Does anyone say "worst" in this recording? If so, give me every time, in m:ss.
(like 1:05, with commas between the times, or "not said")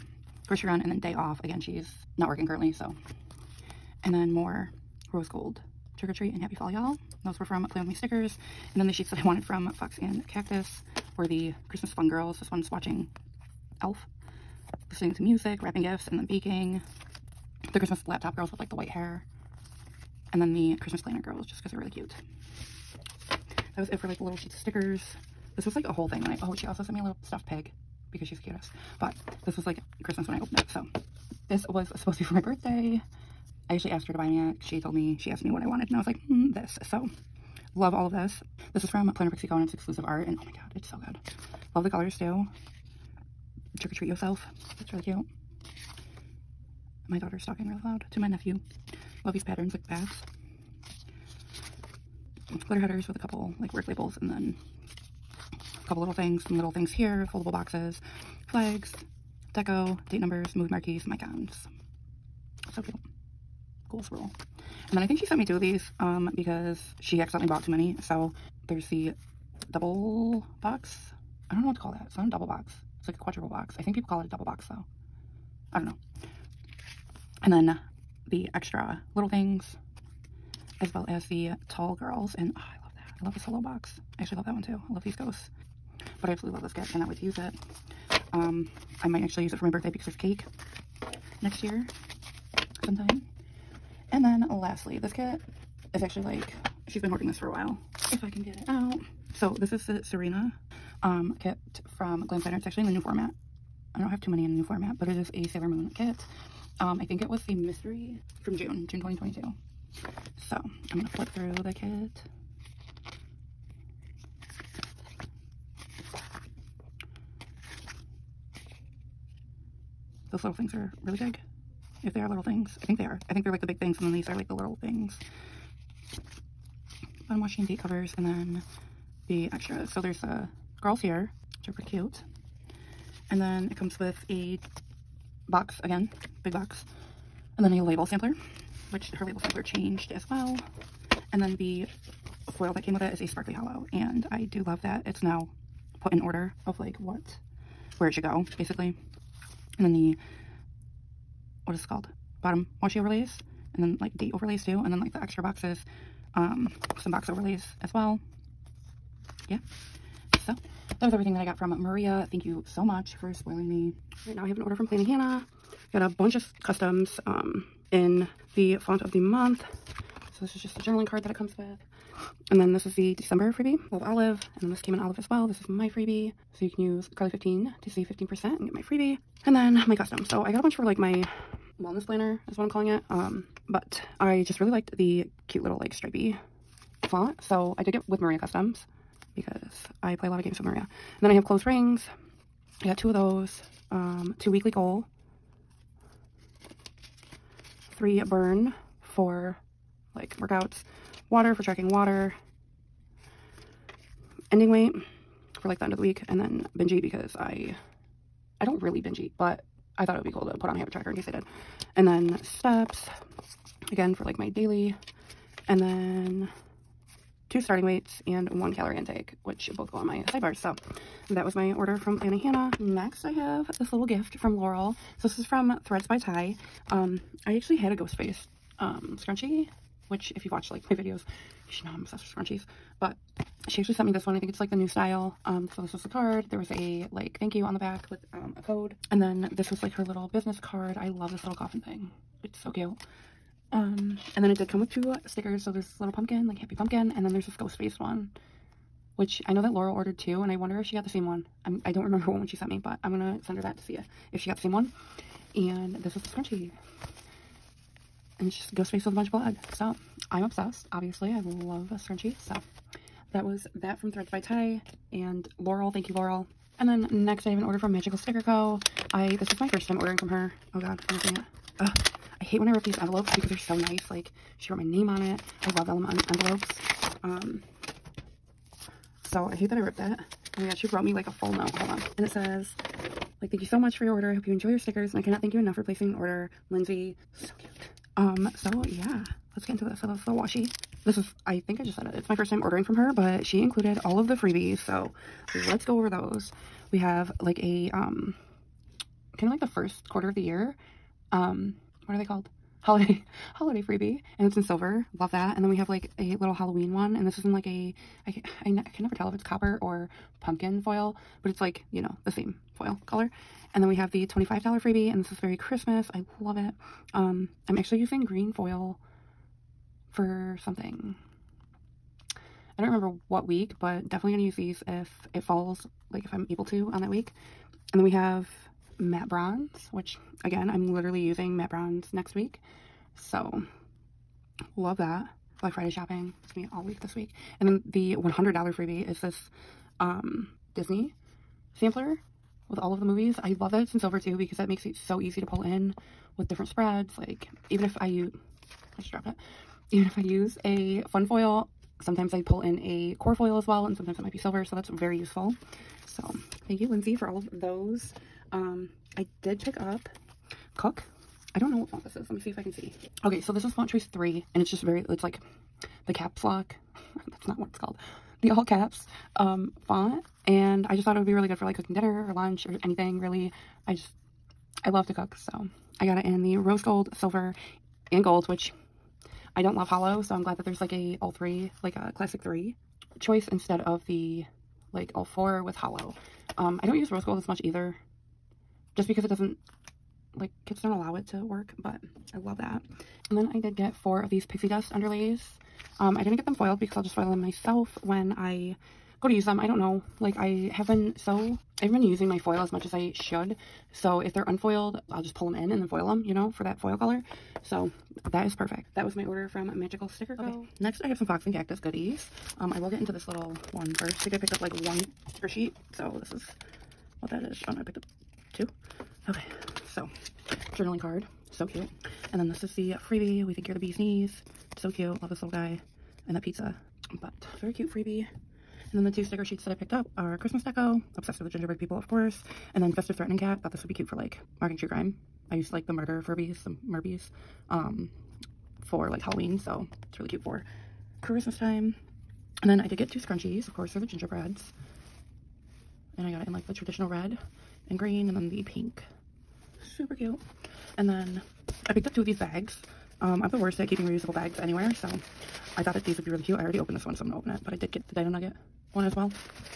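7:33.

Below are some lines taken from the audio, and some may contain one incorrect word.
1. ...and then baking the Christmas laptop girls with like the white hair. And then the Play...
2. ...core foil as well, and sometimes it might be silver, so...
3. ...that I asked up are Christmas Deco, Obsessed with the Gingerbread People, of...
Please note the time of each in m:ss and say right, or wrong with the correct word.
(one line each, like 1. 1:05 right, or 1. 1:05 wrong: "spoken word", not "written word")
1. 0:16 wrong: "Christmas", not "Play"
2. 5:53 right
3. 7:09 wrong: "picked", not "asked".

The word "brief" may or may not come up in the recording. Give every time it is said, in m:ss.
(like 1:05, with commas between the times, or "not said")
not said.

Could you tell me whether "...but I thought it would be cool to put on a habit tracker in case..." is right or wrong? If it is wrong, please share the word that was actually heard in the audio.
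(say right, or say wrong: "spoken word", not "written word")
right.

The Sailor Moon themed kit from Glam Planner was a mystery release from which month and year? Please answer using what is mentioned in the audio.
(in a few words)
June 2022.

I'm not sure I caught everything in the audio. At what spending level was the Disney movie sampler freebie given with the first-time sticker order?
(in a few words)
$100.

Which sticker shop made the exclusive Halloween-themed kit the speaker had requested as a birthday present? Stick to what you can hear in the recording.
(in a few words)
Planner Pixie Co.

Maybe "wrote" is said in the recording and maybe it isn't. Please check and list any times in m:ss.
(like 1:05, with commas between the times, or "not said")
4:34, 4:40.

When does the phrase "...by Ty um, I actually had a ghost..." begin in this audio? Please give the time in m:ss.
3:46.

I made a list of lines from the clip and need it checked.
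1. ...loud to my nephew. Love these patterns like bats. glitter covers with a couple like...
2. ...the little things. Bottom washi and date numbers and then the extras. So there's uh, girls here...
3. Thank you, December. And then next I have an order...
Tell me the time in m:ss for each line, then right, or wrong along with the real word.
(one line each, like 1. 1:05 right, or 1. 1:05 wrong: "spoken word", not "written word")
1. 0:47 wrong: "headers", not "covers"
2. 2:04 wrong: "covers", not "numbers"
3. 4:25 wrong: "Laurel", not "December".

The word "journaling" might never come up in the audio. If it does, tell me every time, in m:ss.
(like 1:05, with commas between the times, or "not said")
2:50, 7:00.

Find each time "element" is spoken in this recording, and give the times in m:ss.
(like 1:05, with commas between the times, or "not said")
4:35.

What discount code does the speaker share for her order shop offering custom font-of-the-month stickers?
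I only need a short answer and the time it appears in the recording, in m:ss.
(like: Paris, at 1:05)
CARLEA15, at 2:57.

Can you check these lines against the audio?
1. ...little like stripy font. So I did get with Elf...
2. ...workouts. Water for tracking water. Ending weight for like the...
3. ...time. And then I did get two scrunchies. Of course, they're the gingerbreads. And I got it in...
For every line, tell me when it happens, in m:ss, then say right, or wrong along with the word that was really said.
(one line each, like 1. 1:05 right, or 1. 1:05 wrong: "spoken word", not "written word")
1. 3:05 wrong: "Maria", not "Elf"
2. 3:20 right
3. 7:21 right.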